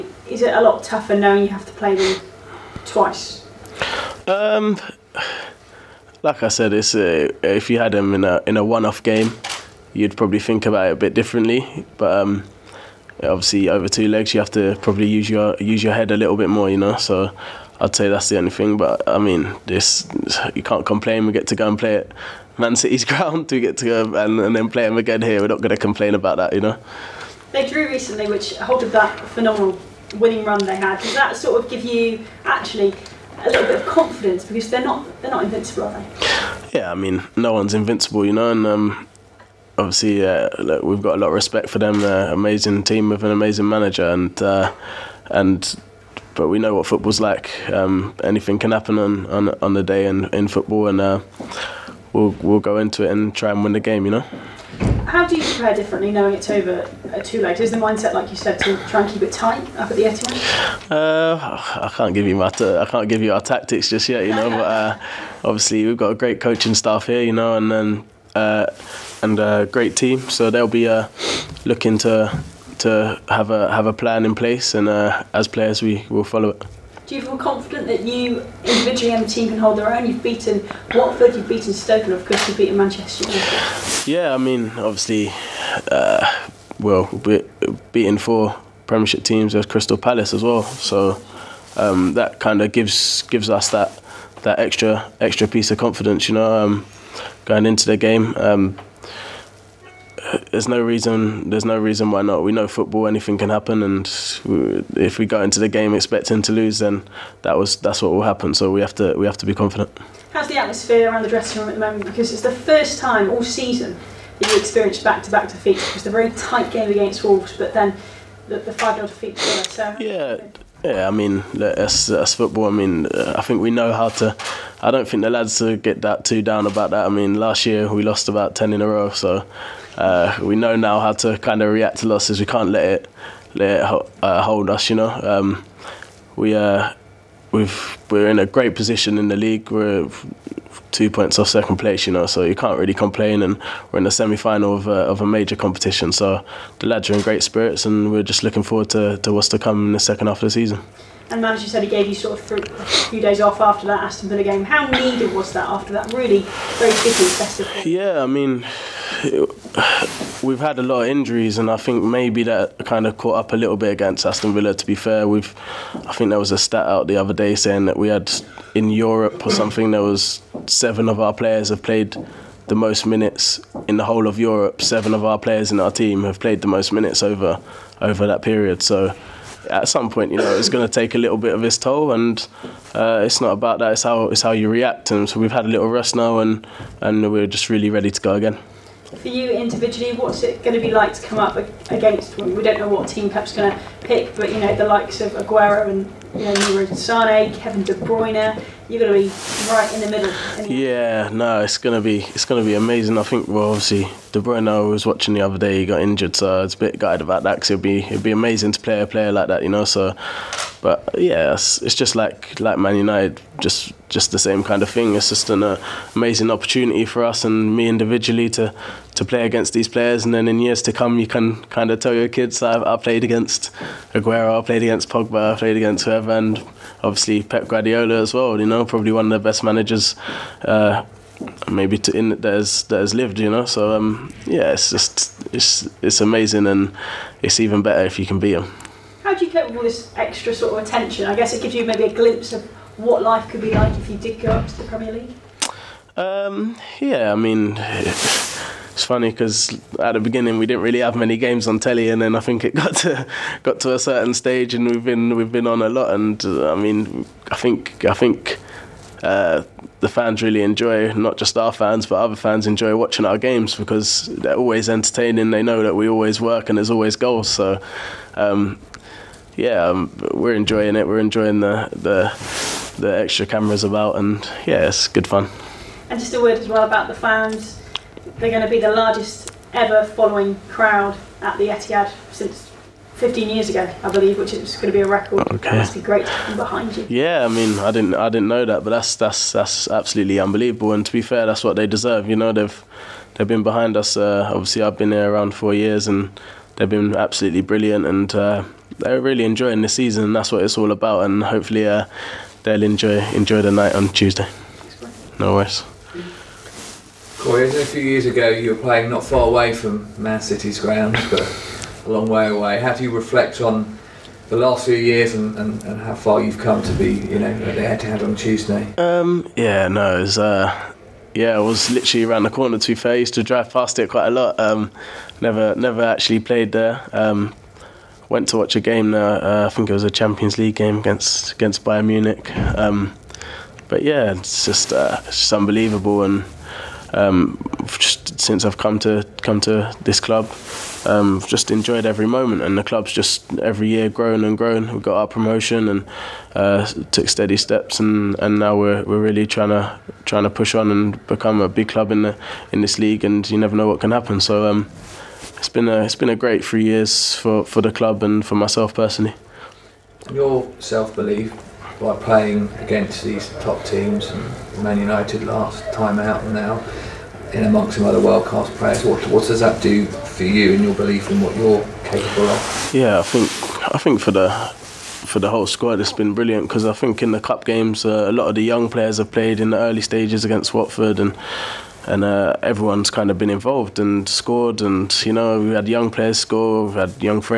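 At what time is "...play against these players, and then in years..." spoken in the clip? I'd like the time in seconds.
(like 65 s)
219 s.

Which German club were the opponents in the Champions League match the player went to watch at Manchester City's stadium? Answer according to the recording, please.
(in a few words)
Bayern Munich.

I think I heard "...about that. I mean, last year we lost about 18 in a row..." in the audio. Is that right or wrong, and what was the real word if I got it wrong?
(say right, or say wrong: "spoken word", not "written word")
wrong: "10", not "18".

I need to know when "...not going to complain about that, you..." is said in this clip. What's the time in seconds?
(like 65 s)
25 s.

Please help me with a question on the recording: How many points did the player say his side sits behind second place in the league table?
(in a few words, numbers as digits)
2.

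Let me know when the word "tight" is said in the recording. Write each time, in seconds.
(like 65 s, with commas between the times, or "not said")
59 s, 116 s.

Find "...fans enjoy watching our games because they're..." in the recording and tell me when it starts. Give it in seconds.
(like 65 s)
262 s.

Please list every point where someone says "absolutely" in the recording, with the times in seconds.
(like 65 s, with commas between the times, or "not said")
289 s, 297 s.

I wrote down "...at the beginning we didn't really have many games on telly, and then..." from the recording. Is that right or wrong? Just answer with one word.
right.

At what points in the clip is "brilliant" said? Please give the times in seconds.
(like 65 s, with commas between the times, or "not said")
297 s, 376 s.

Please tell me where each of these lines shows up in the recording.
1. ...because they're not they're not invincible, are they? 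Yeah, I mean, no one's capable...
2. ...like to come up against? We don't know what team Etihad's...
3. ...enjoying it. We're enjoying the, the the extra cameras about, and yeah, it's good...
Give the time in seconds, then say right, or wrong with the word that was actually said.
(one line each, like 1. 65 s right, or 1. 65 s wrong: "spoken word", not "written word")
1. 34 s wrong: "invincible", not "capable"
2. 190 s wrong: "Pep", not "Etihad"
3. 270 s right.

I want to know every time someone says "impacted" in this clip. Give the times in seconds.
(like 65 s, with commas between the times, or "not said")
not said.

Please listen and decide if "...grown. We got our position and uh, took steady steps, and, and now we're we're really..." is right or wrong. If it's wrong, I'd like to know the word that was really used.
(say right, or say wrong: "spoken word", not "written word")
wrong: "promotion", not "position".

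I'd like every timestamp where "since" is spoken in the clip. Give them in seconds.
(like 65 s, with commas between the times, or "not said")
282 s, 338 s.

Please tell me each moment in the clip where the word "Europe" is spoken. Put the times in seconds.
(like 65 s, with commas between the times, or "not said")
168 s, 174 s.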